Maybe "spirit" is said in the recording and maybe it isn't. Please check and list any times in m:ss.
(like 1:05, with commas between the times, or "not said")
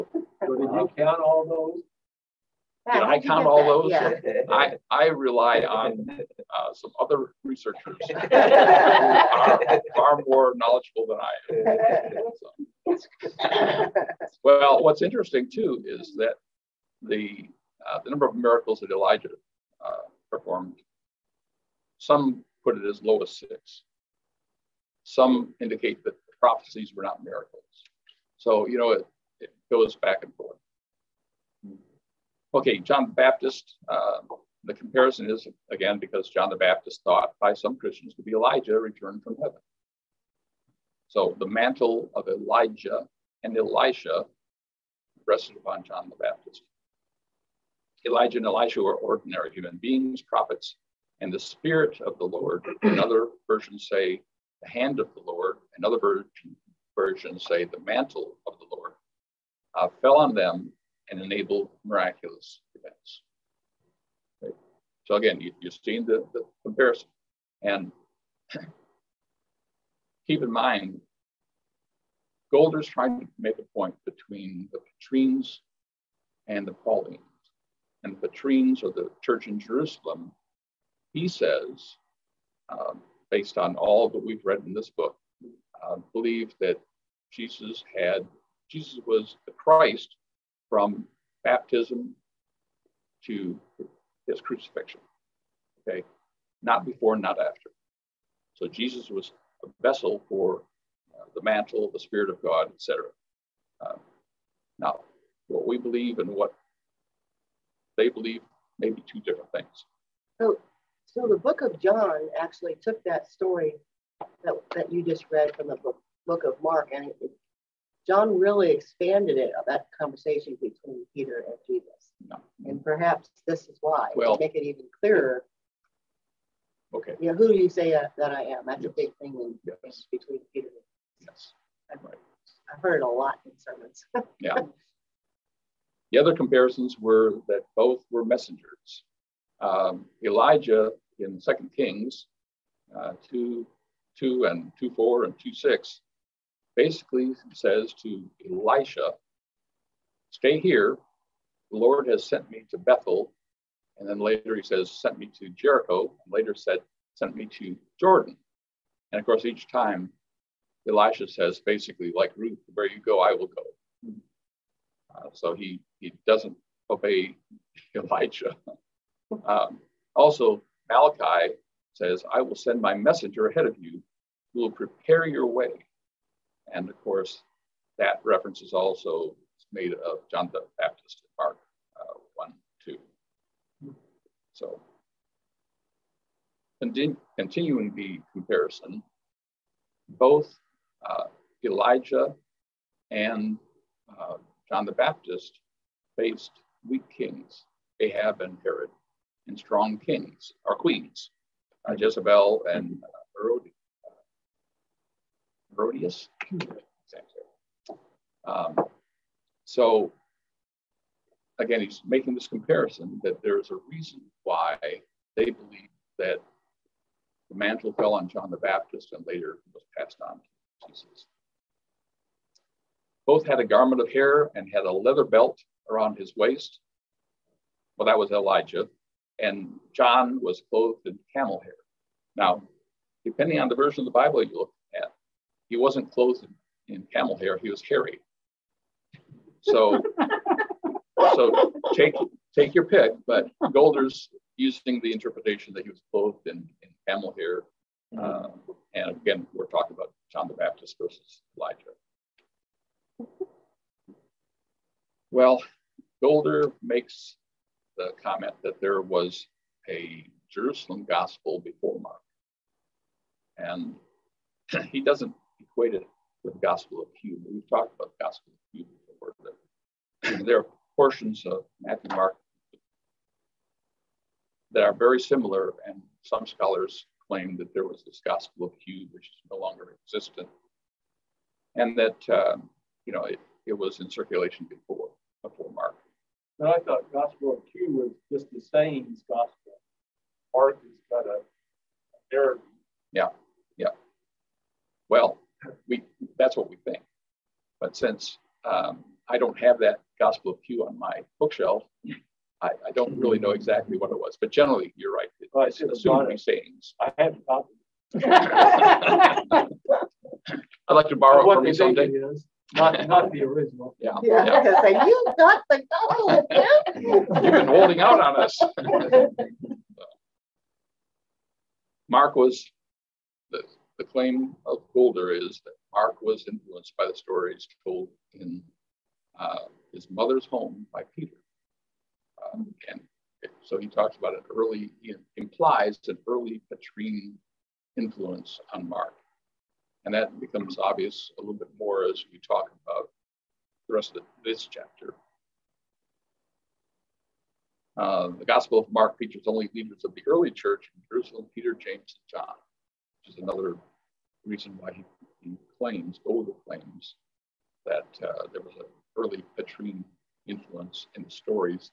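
0:51, 1:41.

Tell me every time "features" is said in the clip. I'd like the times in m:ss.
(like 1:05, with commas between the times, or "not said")
5:49.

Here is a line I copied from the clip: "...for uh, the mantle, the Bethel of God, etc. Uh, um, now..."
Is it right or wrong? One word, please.
wrong.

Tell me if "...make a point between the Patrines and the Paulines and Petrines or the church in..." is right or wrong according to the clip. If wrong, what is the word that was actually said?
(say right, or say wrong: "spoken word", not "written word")
right.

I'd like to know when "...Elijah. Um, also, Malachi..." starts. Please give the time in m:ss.
2:47.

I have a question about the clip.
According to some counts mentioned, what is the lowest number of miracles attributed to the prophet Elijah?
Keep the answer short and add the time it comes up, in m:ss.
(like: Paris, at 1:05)
6, at 0:23.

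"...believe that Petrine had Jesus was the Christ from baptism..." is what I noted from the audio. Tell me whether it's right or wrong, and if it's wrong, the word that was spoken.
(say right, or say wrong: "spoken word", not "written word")
wrong: "Jesus", not "Petrine".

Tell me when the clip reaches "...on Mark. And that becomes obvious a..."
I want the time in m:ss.
5:38.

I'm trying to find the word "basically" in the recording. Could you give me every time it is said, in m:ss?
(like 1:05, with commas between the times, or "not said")
2:26, 2:41.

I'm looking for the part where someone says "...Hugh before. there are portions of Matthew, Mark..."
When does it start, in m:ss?
4:28.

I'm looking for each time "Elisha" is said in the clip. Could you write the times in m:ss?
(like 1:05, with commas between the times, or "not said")
0:43, 0:48, 2:28, 2:40.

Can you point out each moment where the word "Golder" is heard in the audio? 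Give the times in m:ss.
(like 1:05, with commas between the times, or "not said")
1:12, 4:16.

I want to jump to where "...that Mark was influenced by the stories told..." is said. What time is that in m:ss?
5:25.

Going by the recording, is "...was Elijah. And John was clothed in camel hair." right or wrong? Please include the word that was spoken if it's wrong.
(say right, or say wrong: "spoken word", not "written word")
right.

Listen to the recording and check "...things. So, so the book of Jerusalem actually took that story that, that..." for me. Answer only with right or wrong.
wrong.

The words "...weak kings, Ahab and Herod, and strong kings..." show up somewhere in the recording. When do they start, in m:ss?
3:16.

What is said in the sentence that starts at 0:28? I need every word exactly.
So, you know, it, it goes back and forth.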